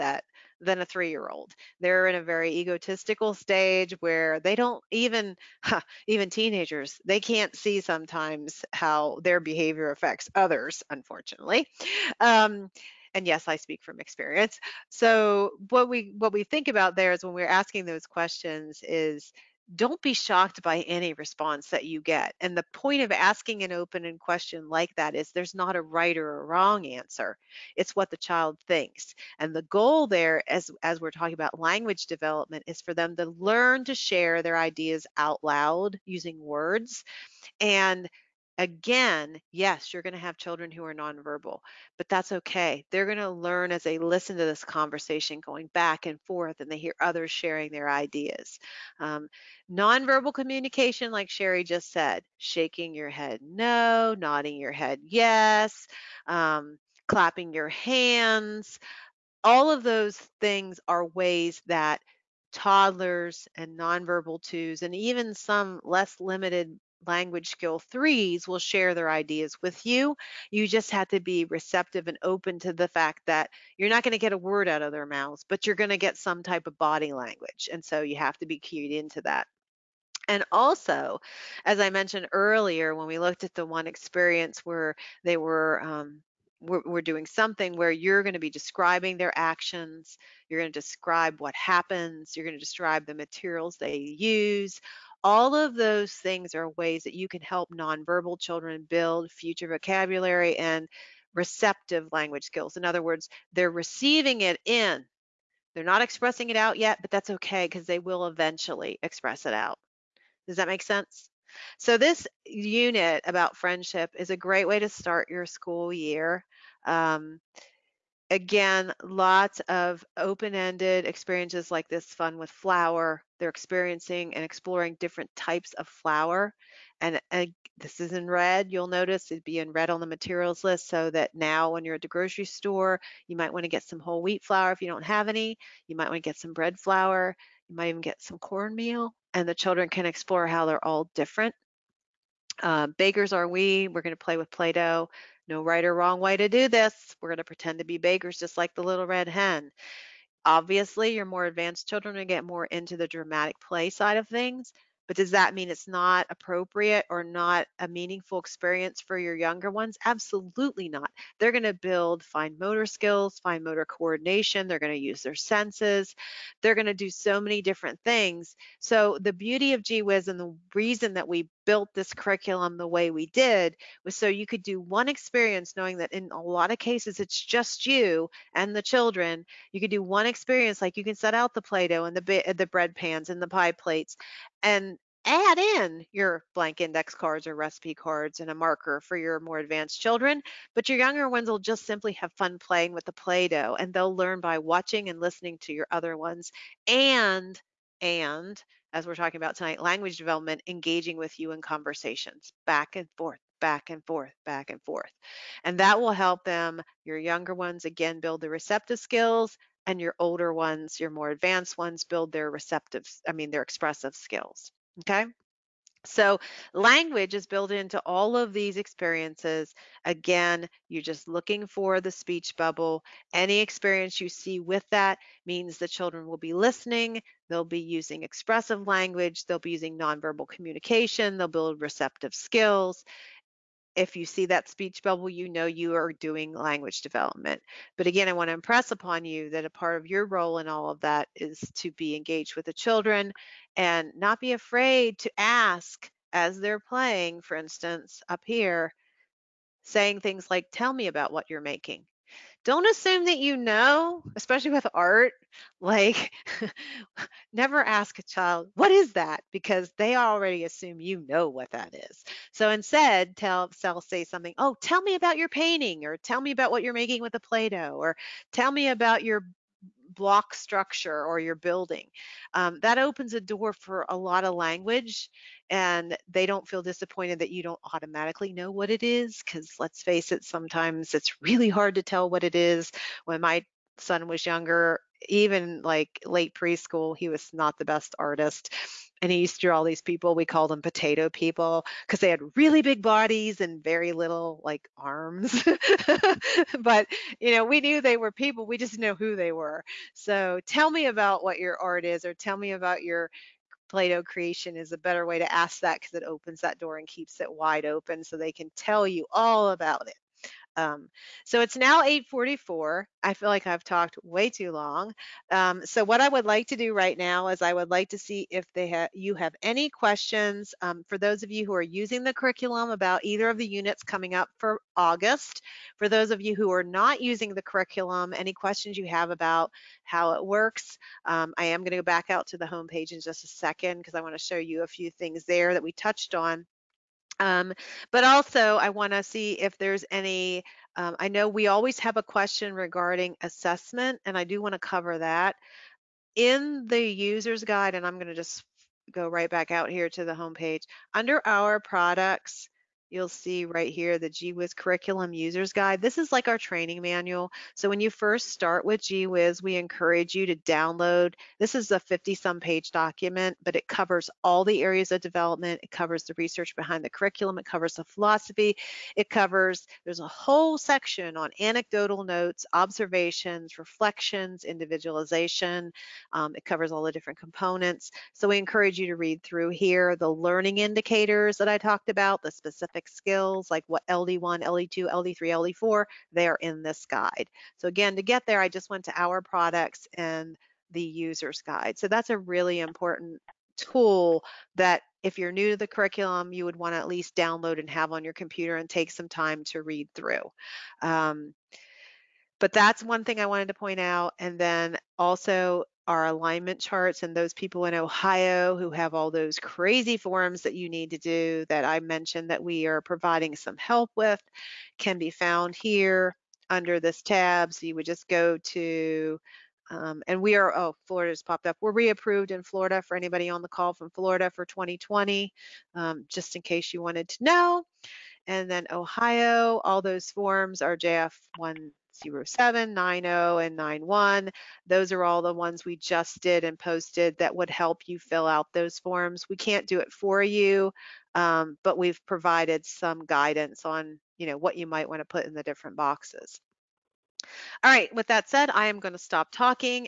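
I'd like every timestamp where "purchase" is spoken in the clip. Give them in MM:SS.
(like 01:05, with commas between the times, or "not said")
not said.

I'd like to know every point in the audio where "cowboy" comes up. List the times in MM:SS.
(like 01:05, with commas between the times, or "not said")
not said.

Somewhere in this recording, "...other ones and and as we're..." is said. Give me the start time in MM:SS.
03:15.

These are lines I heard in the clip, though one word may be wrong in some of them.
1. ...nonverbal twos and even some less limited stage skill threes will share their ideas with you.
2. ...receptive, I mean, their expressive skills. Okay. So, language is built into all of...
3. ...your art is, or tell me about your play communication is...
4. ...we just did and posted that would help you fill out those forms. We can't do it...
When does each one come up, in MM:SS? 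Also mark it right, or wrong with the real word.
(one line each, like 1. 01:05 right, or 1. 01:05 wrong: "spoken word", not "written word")
1. 01:03 wrong: "language", not "stage"
2. 03:32 right
3. 05:01 wrong: "creation", not "communication"
4. 07:15 right.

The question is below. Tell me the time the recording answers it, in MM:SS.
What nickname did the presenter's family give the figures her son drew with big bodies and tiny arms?
04:50.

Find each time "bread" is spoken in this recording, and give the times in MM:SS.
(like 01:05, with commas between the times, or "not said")
02:16, 03:02.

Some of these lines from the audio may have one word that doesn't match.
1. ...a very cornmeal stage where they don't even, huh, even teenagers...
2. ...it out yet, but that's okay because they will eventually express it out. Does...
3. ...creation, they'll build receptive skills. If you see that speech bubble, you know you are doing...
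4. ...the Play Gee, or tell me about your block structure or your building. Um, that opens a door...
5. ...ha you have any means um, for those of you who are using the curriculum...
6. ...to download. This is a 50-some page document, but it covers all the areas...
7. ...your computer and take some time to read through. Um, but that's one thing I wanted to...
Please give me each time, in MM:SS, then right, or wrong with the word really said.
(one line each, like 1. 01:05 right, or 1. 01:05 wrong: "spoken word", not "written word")
1. 00:02 wrong: "egotistical", not "cornmeal"
2. 01:46 right
3. 03:50 wrong: "communication", not "creation"
4. 04:27 wrong: "Doh", not "Gee"
5. 05:18 wrong: "questions", not "means"
6. 06:00 right
7. 06:38 right.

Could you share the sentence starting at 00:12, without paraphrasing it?
Um, and yes, I speak from experience.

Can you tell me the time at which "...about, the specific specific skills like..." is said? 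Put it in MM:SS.
06:22.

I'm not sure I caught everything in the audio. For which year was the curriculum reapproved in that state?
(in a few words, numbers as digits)
2020.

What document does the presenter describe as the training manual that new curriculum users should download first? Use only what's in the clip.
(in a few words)
Gee Whiz Curriculum User's Guide.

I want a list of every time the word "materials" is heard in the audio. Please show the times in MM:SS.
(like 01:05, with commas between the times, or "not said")
01:33, 02:10.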